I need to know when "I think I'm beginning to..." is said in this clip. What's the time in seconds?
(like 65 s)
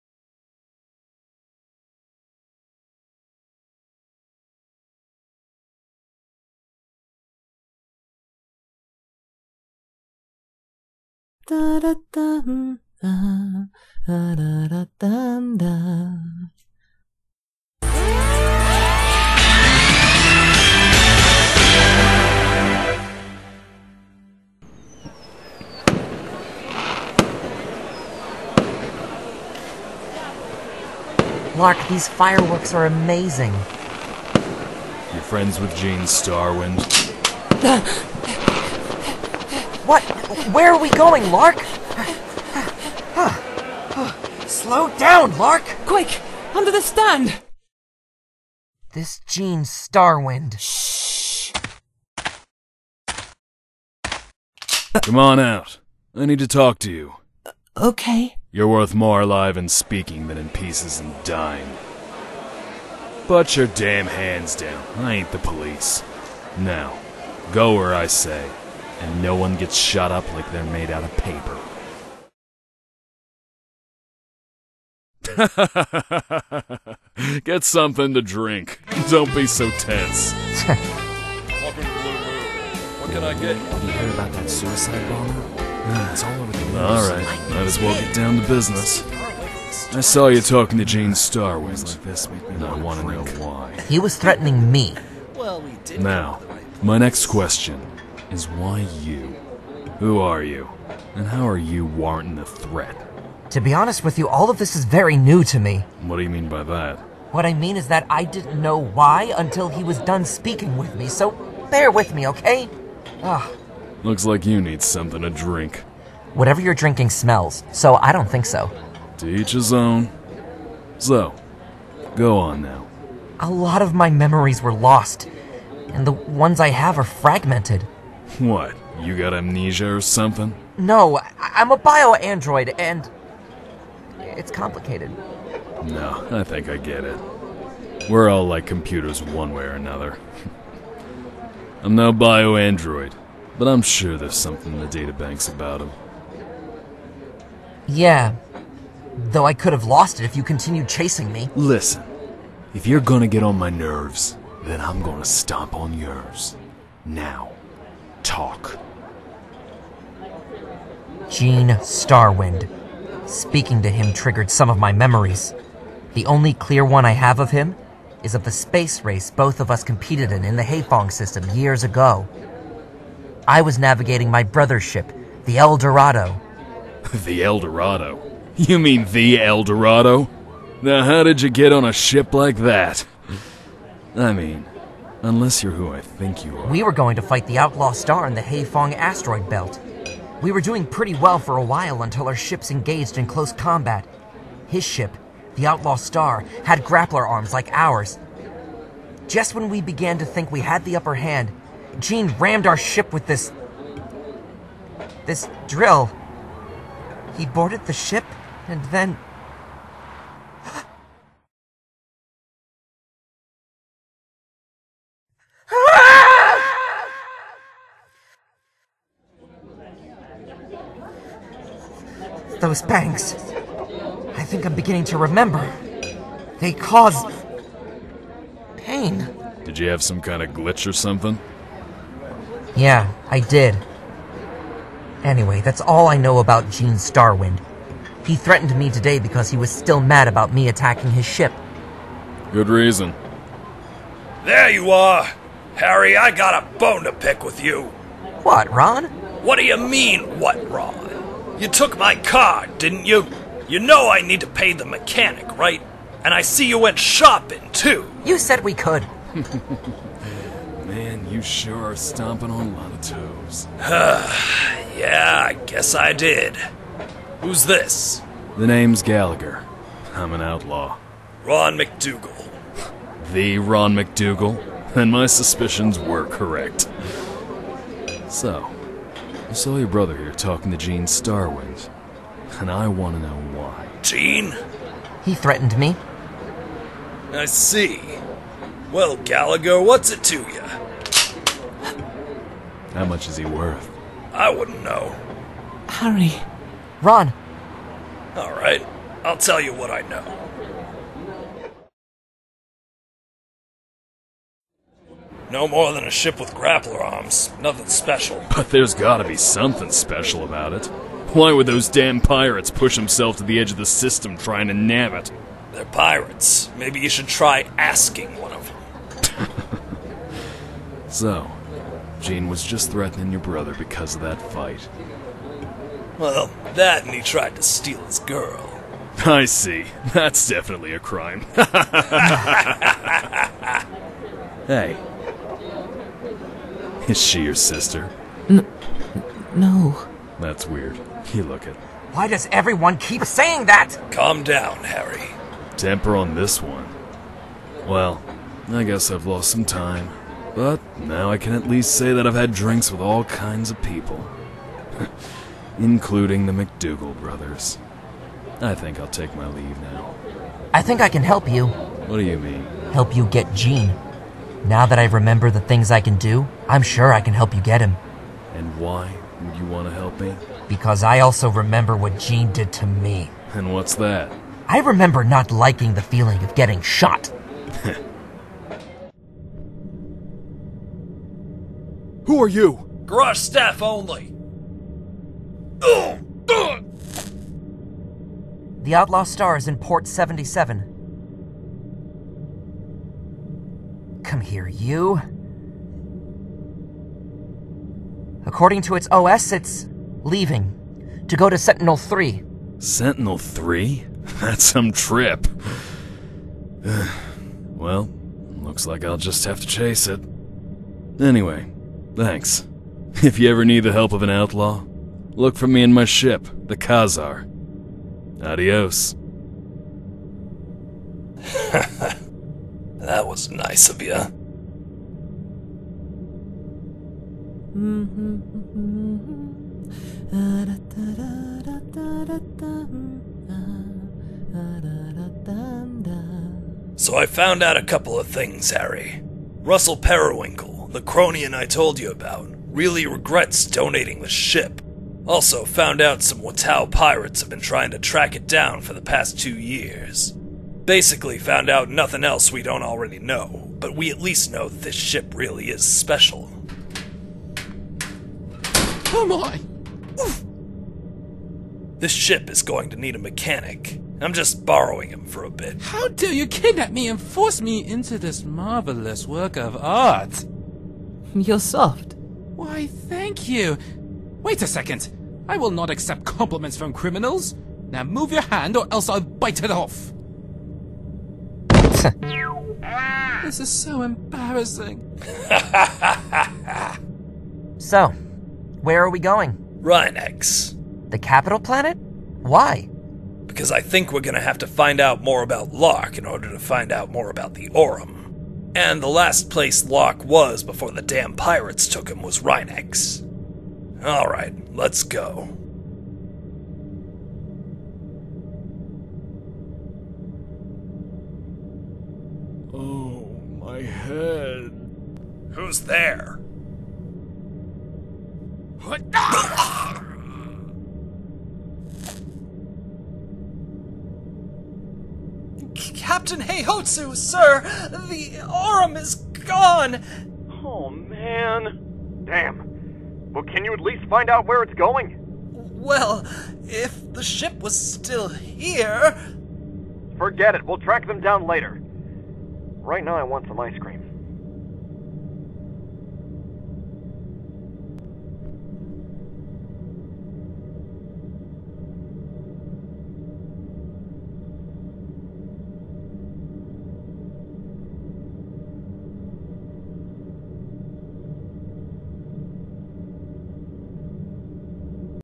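224 s.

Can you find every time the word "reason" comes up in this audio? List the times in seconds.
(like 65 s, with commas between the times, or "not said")
242 s.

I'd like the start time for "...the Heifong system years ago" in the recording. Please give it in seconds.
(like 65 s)
170 s.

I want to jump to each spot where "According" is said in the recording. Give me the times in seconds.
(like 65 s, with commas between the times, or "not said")
398 s.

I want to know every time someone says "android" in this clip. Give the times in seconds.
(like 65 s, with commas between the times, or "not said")
132 s, 142 s.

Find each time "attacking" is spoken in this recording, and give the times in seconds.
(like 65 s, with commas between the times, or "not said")
240 s.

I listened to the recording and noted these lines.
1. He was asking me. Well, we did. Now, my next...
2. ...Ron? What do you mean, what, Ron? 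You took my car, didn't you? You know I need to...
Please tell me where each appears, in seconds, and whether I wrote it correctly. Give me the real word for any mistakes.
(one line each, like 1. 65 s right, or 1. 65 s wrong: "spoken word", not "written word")
1. 93 s wrong: "threatening", not "asking"
2. 248 s right.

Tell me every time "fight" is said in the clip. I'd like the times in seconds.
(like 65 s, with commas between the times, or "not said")
187 s, 324 s.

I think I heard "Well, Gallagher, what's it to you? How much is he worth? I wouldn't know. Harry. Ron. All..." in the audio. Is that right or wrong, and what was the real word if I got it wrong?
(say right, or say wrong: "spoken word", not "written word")
right.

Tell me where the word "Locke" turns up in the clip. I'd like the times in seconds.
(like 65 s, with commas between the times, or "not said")
495 s, 499 s.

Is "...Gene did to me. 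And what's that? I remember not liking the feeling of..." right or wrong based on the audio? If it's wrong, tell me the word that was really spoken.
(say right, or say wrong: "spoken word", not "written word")
right.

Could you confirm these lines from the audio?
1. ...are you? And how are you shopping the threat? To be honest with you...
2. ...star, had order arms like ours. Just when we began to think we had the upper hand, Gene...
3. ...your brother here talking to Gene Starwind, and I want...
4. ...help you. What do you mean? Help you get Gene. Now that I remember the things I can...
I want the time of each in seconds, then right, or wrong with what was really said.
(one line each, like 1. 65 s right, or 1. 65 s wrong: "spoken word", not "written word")
1. 100 s wrong: "warranting", not "shopping"
2. 195 s wrong: "grappler", not "order"
3. 279 s right
4. 361 s right.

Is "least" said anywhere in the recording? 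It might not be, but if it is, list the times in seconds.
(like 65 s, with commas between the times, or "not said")
351 s, 454 s, 533 s.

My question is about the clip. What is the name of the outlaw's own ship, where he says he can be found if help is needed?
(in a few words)
Khazar.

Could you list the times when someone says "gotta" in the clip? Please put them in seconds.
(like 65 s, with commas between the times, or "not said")
308 s.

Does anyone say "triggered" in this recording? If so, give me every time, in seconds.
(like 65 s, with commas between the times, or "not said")
164 s.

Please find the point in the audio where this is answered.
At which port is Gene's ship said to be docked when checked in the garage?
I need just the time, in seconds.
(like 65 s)
389 s.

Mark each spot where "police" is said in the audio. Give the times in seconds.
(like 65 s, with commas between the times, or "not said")
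65 s.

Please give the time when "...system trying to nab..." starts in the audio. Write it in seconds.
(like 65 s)
313 s.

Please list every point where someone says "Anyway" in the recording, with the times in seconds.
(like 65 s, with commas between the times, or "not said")
235 s, 411 s.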